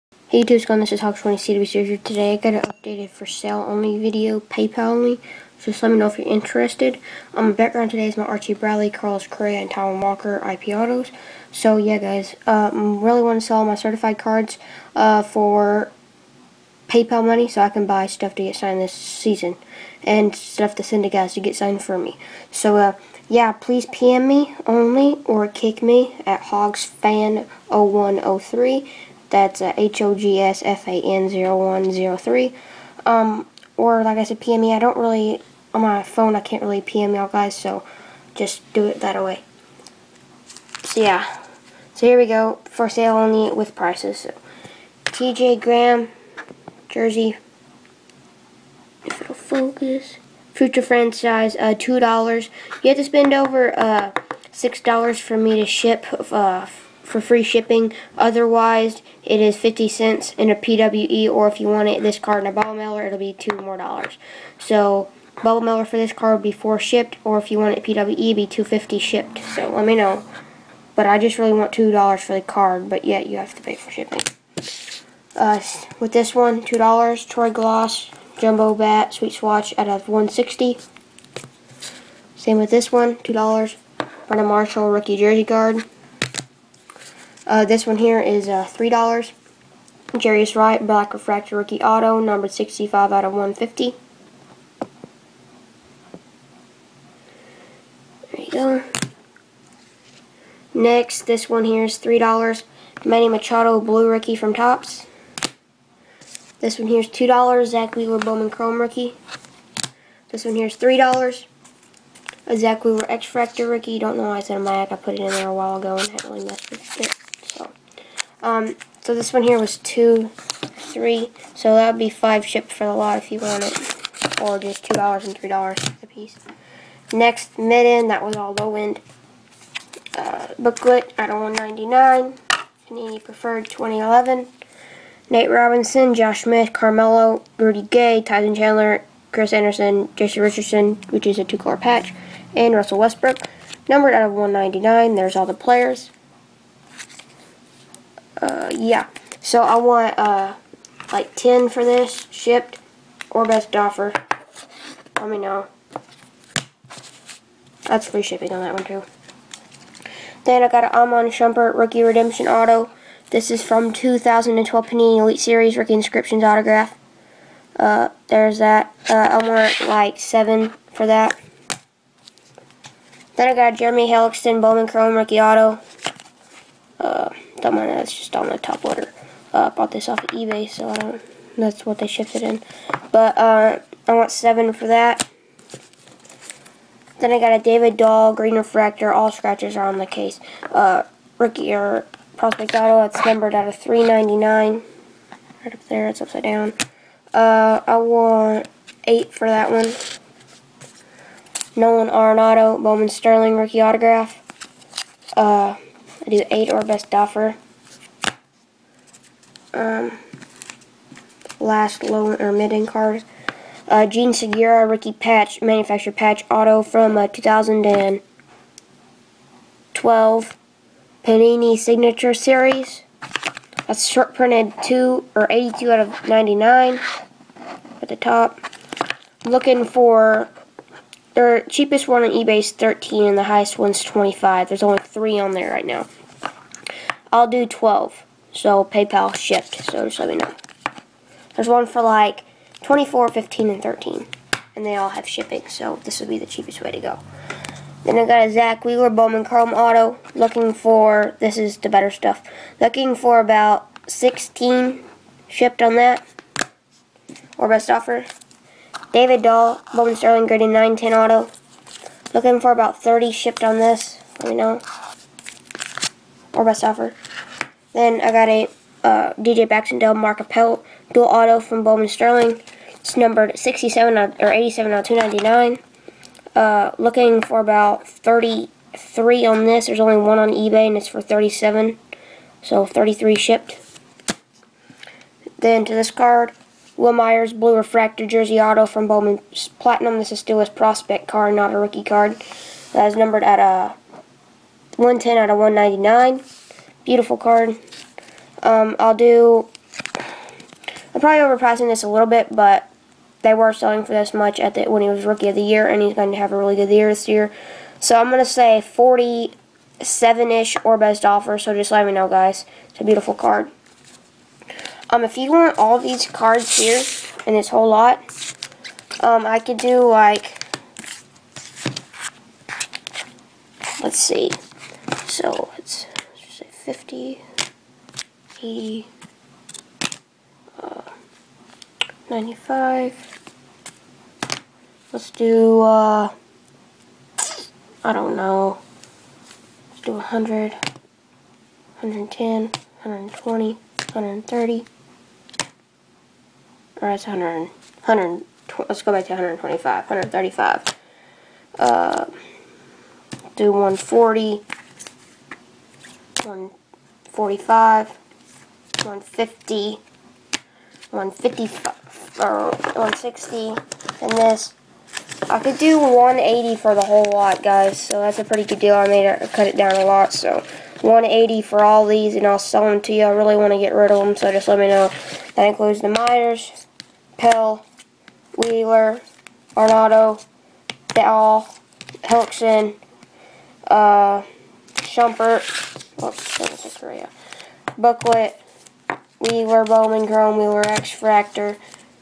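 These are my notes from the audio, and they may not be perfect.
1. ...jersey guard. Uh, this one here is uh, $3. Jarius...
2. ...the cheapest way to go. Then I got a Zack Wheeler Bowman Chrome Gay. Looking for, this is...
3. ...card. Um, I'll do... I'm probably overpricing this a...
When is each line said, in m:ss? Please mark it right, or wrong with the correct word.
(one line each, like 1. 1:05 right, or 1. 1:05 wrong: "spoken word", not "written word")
1. 1:25 right
2. 4:06 wrong: "Auto", not "Gay"
3. 4:57 right.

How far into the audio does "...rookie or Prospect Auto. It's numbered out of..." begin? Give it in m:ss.
3:11.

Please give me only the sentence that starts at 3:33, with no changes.
Uh, Jean Segura, Ricky Patch, manufactured patch auto from uh, 2012 Panini Signature Series.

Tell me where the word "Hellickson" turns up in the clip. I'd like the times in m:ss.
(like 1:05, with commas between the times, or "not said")
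2:54, 6:22.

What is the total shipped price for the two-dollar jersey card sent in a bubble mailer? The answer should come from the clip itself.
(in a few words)
4.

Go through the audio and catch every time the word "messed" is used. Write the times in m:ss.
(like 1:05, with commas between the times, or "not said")
1:56.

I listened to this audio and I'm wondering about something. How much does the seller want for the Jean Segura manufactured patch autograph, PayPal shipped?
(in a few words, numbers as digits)
12.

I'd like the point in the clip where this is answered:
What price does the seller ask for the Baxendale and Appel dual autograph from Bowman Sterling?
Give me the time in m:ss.
4:42.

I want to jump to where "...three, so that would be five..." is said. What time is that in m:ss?
2:00.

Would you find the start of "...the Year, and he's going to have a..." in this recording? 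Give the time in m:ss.
5:05.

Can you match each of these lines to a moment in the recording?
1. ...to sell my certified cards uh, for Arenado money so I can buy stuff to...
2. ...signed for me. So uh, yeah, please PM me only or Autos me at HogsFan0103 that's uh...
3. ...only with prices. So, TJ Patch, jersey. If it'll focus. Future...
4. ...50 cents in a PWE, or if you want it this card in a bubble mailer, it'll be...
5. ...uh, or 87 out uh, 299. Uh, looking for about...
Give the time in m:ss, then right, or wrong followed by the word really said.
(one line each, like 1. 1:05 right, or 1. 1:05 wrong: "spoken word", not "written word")
1. 0:13 wrong: "PayPal", not "Arenado"
2. 0:21 wrong: "Kik", not "Autos"
3. 0:43 wrong: "Graham", not "Patch"
4. 0:59 right
5. 4:34 right.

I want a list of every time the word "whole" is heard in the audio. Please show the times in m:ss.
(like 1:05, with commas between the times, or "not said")
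5:17, 6:07.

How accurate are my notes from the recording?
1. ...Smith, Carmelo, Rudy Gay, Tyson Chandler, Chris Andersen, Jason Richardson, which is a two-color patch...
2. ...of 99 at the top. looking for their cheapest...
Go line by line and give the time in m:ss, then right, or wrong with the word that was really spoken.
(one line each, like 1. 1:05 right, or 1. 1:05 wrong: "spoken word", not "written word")
1. 2:16 right
2. 3:46 right.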